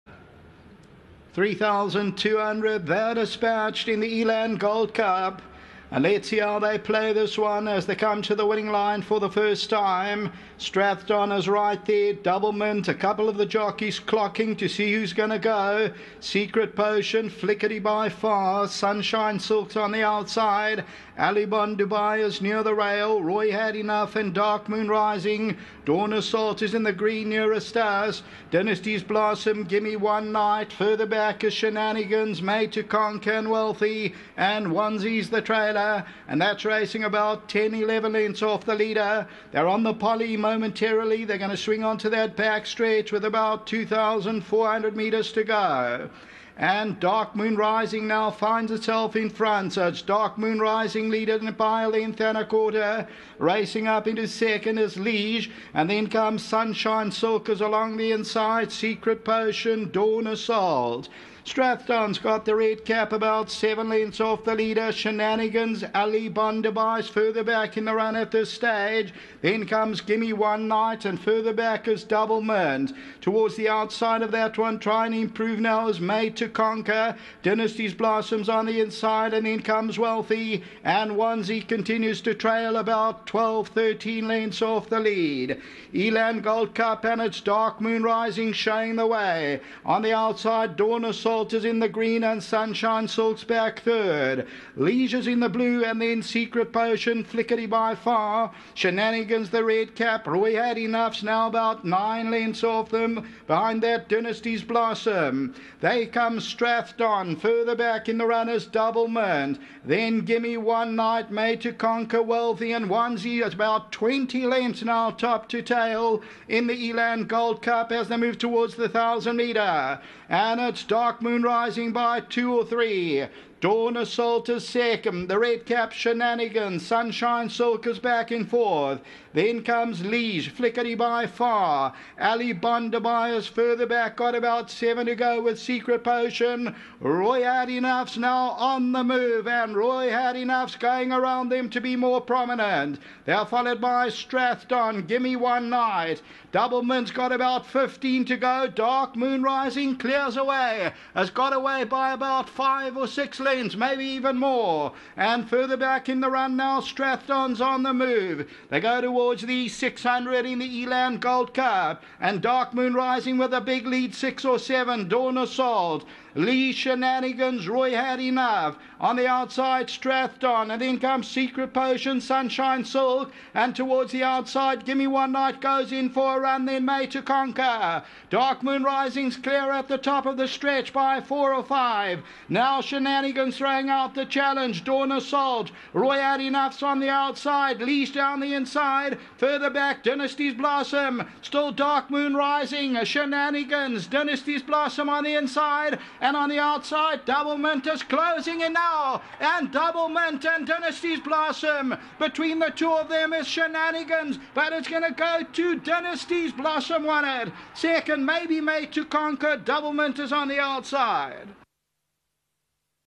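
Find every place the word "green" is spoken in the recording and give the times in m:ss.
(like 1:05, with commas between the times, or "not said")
0:26, 1:31.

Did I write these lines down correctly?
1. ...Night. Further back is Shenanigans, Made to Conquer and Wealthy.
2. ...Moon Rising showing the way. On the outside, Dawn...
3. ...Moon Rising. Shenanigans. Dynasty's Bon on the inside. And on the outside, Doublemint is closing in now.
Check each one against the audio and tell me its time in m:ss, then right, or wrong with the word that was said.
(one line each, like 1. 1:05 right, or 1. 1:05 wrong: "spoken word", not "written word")
1. 0:30 right
2. 1:27 right
3. 3:12 wrong: "Blossom", not "Bon".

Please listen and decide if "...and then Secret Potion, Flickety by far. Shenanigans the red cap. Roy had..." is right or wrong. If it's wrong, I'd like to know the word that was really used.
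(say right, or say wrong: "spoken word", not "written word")
right.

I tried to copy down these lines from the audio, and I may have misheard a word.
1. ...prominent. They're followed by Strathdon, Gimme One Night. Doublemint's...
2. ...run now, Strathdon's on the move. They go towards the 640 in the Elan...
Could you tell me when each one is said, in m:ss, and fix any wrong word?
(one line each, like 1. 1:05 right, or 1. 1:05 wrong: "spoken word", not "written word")
1. 2:22 right
2. 2:36 wrong: "600", not "640".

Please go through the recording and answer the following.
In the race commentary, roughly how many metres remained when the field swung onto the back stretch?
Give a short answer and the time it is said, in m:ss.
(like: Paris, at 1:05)
2,400, at 0:43.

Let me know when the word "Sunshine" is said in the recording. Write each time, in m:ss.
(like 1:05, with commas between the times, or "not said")
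0:18, 0:56, 1:32, 2:06, 2:52.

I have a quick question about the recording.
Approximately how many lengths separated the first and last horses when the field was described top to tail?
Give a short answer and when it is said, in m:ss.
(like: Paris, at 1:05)
20, at 1:53.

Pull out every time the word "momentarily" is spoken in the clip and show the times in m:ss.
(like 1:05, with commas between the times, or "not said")
0:40.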